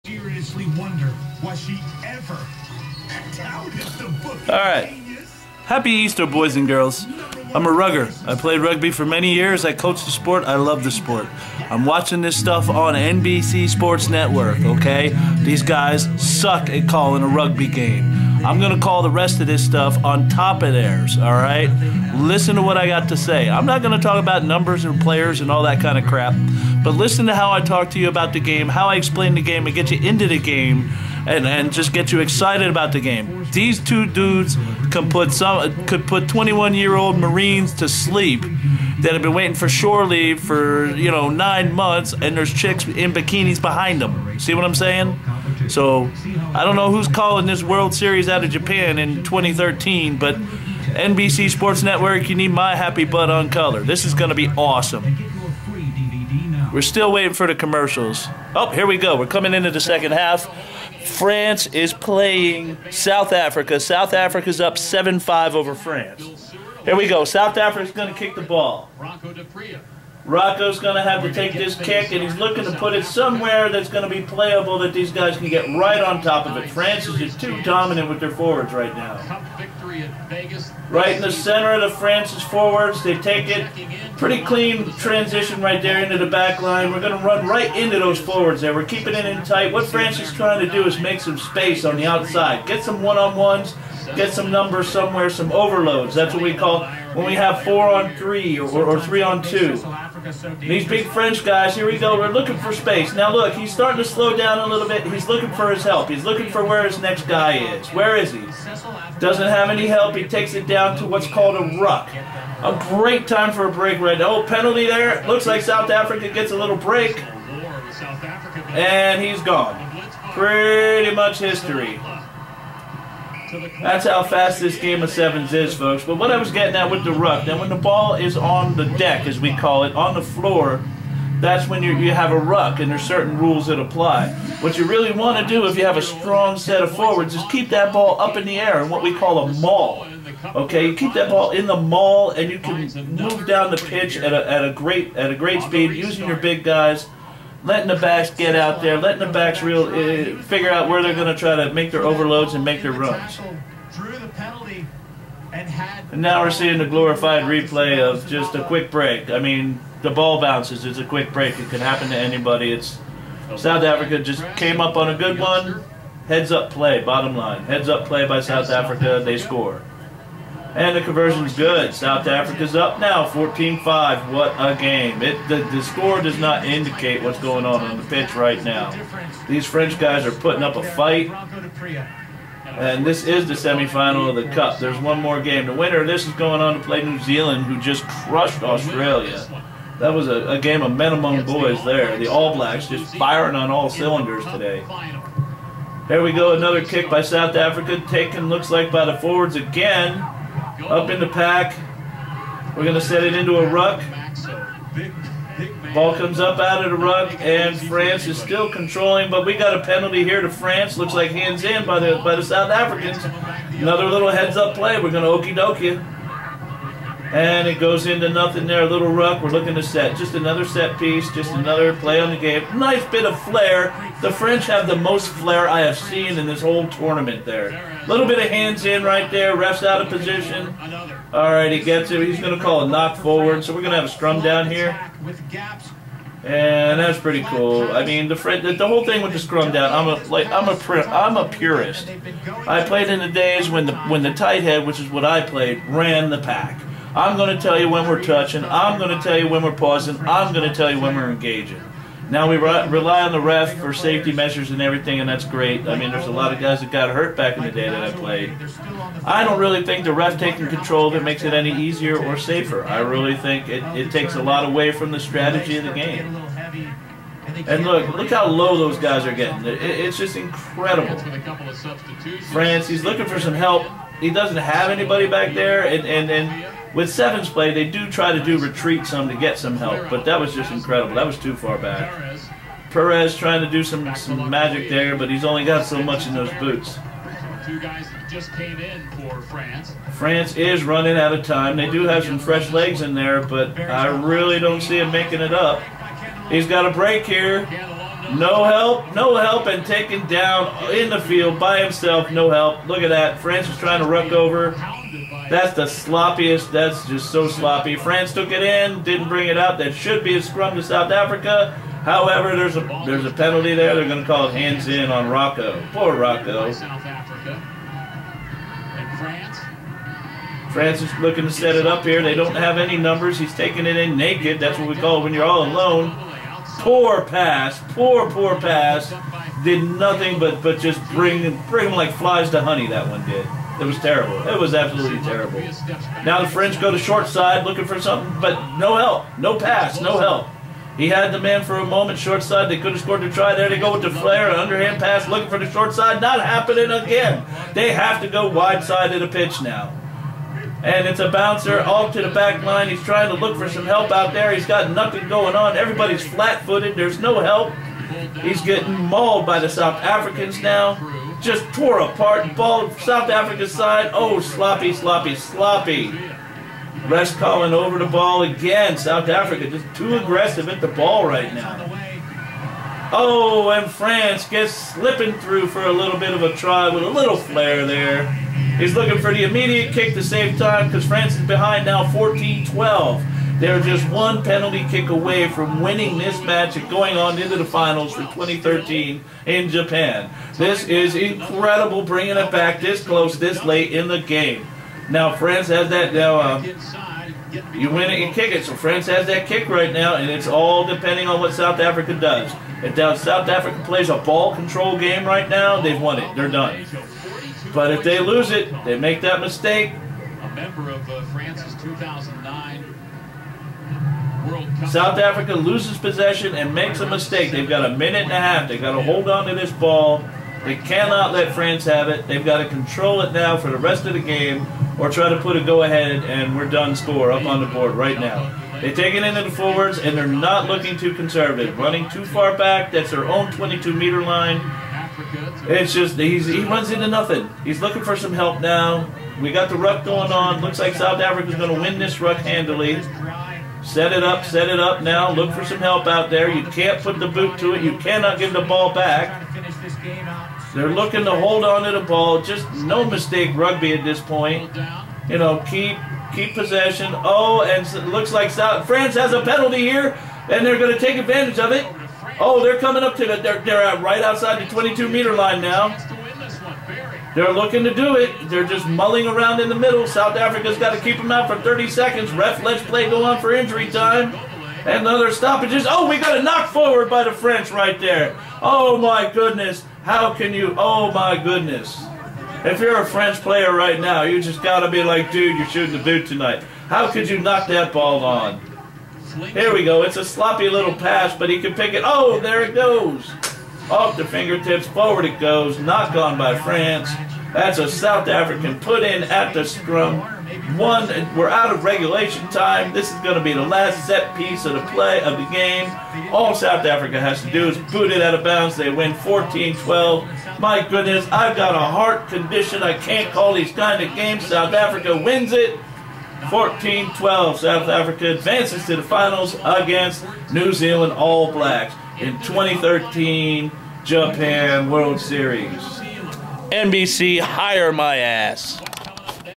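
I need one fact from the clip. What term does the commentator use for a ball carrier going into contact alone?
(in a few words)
naked.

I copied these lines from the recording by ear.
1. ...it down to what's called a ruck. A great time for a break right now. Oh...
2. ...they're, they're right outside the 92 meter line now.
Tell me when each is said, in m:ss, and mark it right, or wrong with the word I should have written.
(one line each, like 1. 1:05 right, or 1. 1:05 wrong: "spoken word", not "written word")
1. 1:50 right
2. 7:43 wrong: "22", not "92".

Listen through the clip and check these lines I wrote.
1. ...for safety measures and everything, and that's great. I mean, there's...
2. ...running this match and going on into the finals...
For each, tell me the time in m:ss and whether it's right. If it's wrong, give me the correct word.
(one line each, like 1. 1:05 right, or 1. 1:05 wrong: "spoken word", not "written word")
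1. 4:13 right
2. 6:25 wrong: "winning", not "running".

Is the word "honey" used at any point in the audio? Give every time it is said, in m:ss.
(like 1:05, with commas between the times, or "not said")
5:32.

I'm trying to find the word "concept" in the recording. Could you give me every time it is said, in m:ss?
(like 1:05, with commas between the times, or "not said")
not said.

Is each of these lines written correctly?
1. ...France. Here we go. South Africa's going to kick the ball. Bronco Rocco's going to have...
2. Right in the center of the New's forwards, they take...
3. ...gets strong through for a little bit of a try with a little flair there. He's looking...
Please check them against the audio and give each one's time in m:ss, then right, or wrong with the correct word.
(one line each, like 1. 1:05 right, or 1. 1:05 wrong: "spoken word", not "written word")
1. 1:05 right
2. 1:20 wrong: "France", not "New"
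3. 6:14 wrong: "slipping", not "strong".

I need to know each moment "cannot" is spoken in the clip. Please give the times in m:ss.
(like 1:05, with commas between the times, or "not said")
7:00, 7:27.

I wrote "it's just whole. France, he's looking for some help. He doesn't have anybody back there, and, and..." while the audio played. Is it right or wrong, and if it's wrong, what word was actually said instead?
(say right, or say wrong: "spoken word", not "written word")
wrong: "incredible", not "whole".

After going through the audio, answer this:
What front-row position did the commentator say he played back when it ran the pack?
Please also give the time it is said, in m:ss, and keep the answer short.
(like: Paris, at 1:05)
tight head, at 4:04.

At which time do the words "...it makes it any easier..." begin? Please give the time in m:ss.
4:21.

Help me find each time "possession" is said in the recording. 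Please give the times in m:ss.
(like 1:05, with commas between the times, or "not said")
6:55, 7:36.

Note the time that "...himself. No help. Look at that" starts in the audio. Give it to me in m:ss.
5:01.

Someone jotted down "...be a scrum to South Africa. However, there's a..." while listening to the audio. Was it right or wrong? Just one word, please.
right.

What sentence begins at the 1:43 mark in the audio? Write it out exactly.
Now look, he's starting to slow down a little bit.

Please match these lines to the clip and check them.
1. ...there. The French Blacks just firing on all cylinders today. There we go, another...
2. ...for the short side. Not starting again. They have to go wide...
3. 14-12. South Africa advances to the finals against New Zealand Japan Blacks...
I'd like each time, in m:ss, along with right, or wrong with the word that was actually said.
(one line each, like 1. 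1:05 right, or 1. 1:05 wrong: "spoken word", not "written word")
1. 3:11 wrong: "All", not "French"
2. 5:45 wrong: "happening", not "starting"
3. 8:36 wrong: "All", not "Japan".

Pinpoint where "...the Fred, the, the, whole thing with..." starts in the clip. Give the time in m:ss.
3:58.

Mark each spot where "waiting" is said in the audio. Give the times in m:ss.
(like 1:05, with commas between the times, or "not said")
0:39, 0:57.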